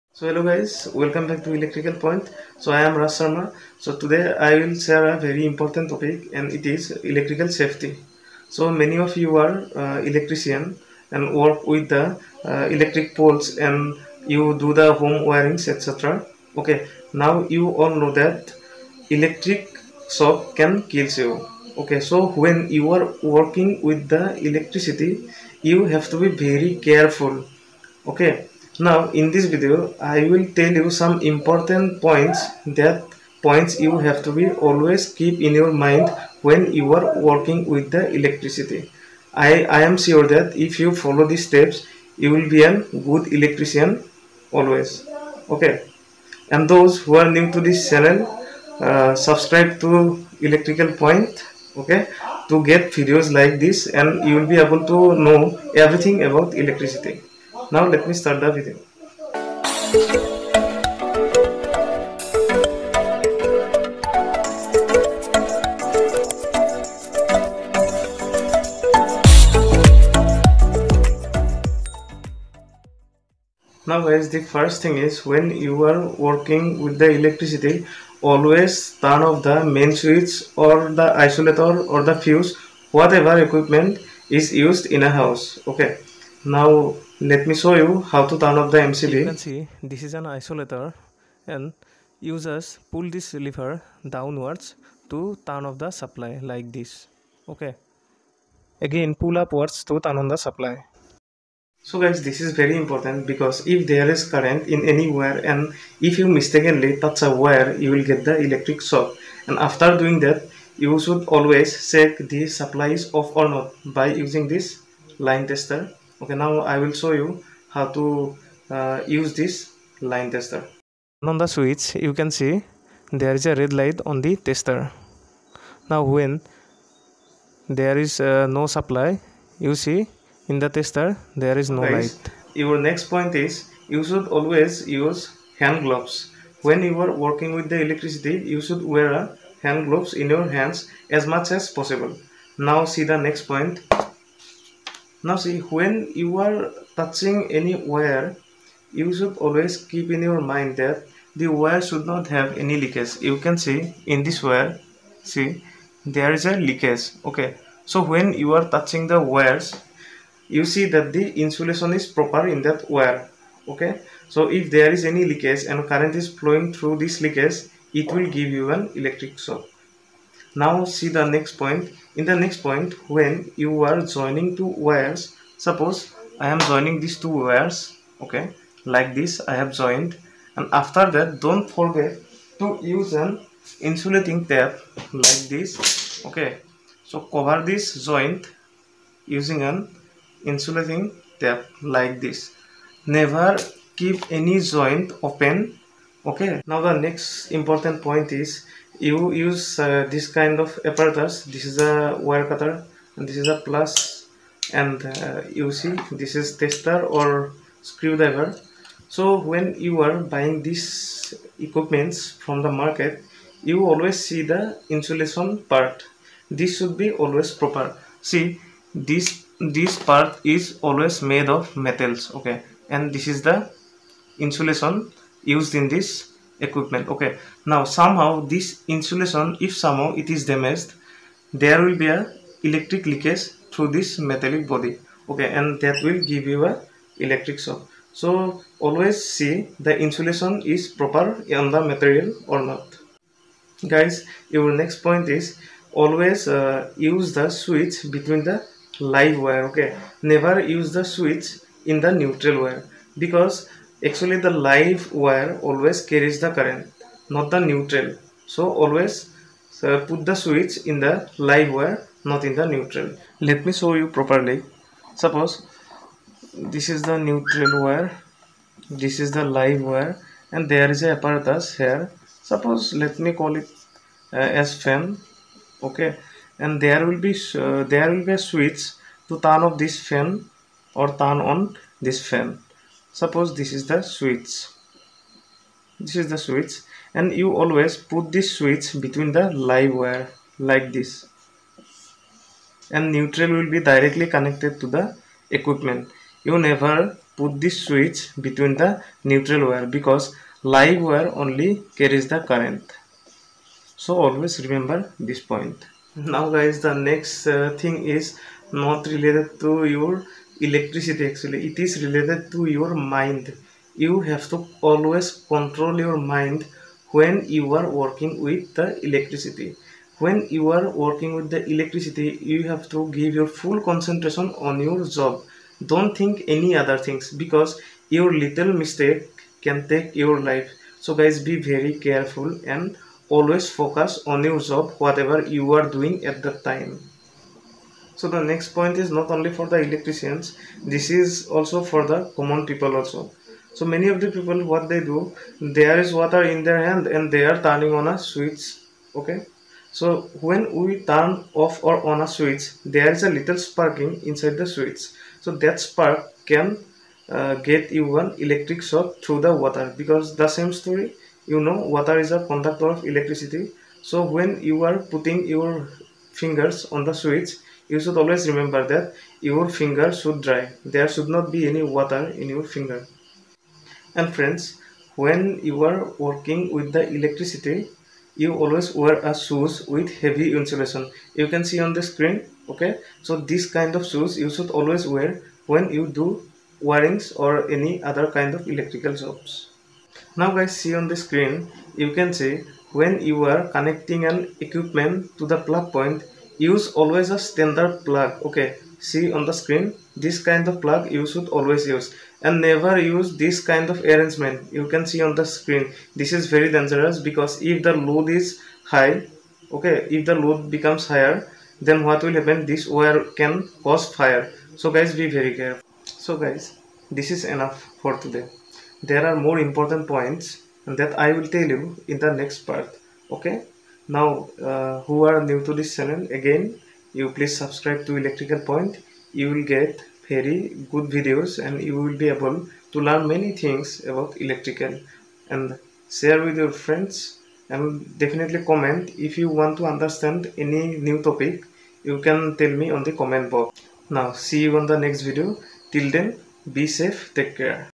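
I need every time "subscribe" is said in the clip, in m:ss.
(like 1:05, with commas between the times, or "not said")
0:49, 7:07.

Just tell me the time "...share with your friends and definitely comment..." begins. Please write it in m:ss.
7:16.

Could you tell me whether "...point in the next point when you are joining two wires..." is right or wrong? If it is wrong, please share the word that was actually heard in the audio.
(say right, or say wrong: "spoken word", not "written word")
right.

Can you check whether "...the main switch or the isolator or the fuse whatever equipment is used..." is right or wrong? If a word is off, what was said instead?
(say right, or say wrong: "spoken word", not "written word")
right.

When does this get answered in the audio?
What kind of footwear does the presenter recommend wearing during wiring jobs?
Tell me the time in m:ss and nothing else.
6:19.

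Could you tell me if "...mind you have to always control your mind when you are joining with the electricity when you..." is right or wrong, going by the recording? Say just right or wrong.
wrong.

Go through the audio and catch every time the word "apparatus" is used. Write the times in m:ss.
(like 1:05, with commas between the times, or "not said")
3:20, 4:31.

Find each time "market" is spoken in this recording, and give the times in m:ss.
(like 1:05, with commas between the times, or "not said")
3:32.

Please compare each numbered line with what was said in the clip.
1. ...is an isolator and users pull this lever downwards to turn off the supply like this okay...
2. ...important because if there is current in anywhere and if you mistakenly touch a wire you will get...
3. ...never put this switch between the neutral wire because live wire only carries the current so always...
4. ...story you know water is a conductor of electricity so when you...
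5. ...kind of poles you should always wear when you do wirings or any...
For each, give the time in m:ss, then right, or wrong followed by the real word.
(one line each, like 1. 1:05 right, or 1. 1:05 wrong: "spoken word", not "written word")
1. 1:30 right
2. 1:42 right
3. 4:56 right
4. 6:00 right
5. 6:23 wrong: "shoes", not "poles".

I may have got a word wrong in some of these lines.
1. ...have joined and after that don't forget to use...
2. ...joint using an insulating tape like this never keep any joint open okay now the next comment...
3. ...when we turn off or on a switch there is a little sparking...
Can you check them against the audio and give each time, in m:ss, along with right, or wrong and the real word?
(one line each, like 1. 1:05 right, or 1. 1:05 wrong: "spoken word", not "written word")
1. 2:59 right
2. 3:08 wrong: "important", not "comment"
3. 5:50 right.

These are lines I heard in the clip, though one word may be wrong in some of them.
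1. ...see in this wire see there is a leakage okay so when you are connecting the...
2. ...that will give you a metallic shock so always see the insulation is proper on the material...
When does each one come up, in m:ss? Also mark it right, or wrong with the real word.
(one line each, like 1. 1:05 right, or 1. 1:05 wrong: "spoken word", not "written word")
1. 2:33 wrong: "touching", not "connecting"
2. 3:55 wrong: "electric", not "metallic".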